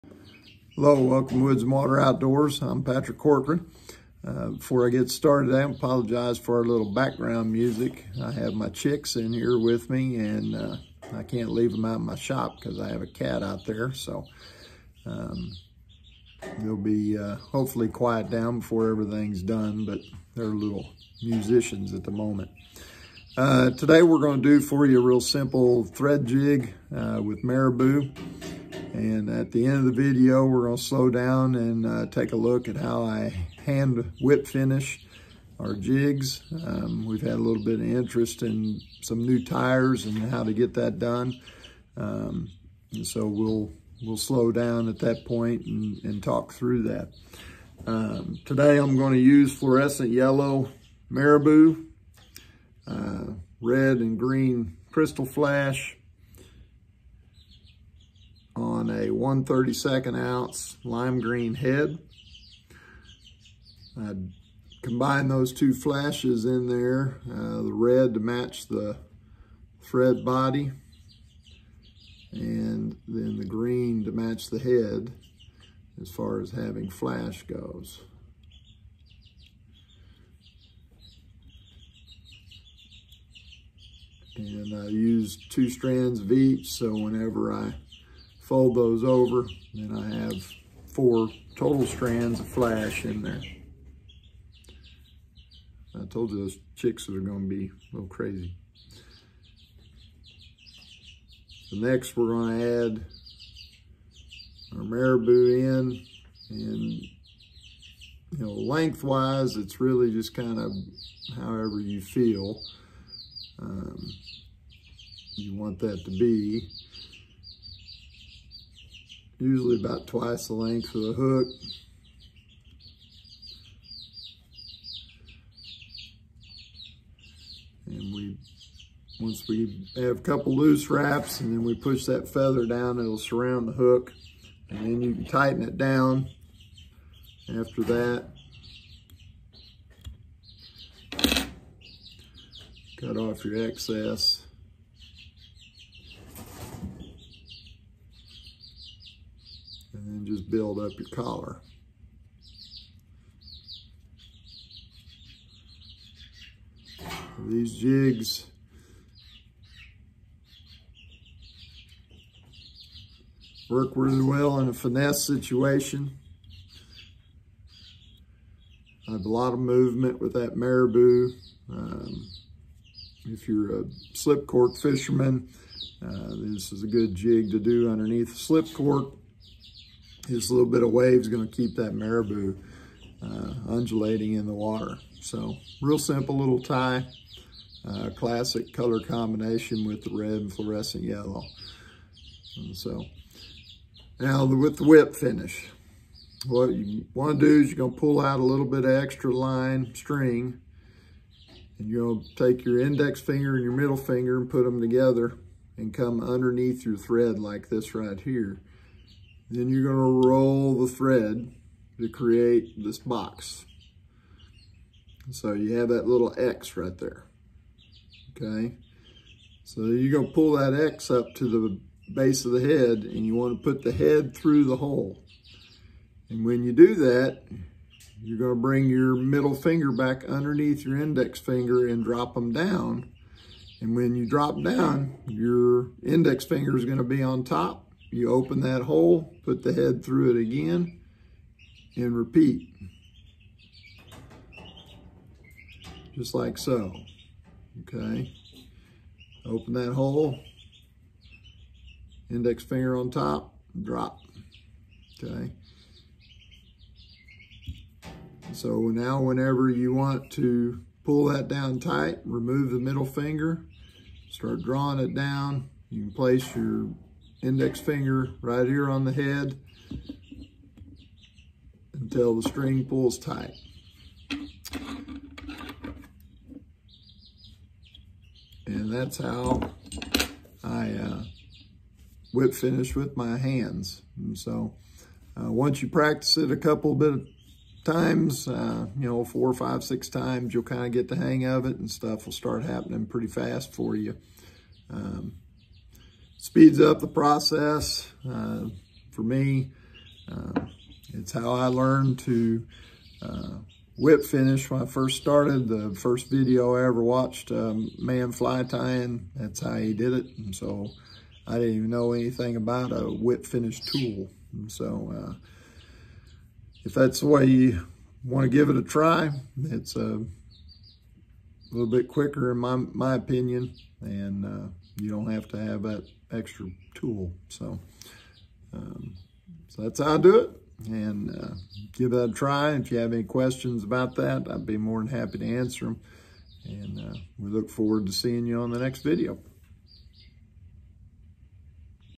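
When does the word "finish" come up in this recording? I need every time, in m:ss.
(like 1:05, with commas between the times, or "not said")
0:34, 3:15, 4:42, 5:04, 5:13.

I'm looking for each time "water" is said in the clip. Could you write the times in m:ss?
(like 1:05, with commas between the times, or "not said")
0:01, 3:04.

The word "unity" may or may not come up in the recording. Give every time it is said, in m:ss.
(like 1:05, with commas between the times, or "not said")
not said.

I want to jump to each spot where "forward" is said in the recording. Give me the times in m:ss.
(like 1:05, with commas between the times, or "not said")
5:37.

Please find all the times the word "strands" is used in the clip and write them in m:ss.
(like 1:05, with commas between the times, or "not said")
1:25, 1:31.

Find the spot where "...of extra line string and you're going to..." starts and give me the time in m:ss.
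3:18.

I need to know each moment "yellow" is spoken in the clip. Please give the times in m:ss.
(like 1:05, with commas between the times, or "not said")
0:50, 3:11.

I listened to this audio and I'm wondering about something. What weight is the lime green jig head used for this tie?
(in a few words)
1/32 ounce.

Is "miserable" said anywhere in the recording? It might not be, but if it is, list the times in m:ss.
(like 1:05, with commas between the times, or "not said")
not said.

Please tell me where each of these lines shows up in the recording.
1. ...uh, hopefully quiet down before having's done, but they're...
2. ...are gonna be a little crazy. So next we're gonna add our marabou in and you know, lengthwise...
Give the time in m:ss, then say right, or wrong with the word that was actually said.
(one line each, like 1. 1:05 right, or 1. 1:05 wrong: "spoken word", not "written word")
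1. 0:17 wrong: "everything", not "having"
2. 1:37 right.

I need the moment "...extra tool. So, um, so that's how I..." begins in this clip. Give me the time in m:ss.
5:26.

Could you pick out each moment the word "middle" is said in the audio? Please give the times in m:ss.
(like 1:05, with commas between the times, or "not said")
3:23, 3:49, 4:22.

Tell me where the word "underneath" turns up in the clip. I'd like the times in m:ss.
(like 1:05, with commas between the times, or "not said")
2:57, 3:26, 3:50.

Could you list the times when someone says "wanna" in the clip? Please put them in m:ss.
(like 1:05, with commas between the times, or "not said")
3:43.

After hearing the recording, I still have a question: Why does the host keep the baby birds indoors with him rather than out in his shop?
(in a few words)
A cat.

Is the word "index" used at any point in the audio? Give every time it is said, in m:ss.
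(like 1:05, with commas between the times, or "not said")
3:22, 3:50, 3:56, 4:12, 4:27.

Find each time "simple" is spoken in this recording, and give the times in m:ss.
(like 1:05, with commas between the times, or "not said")
0:25, 3:05.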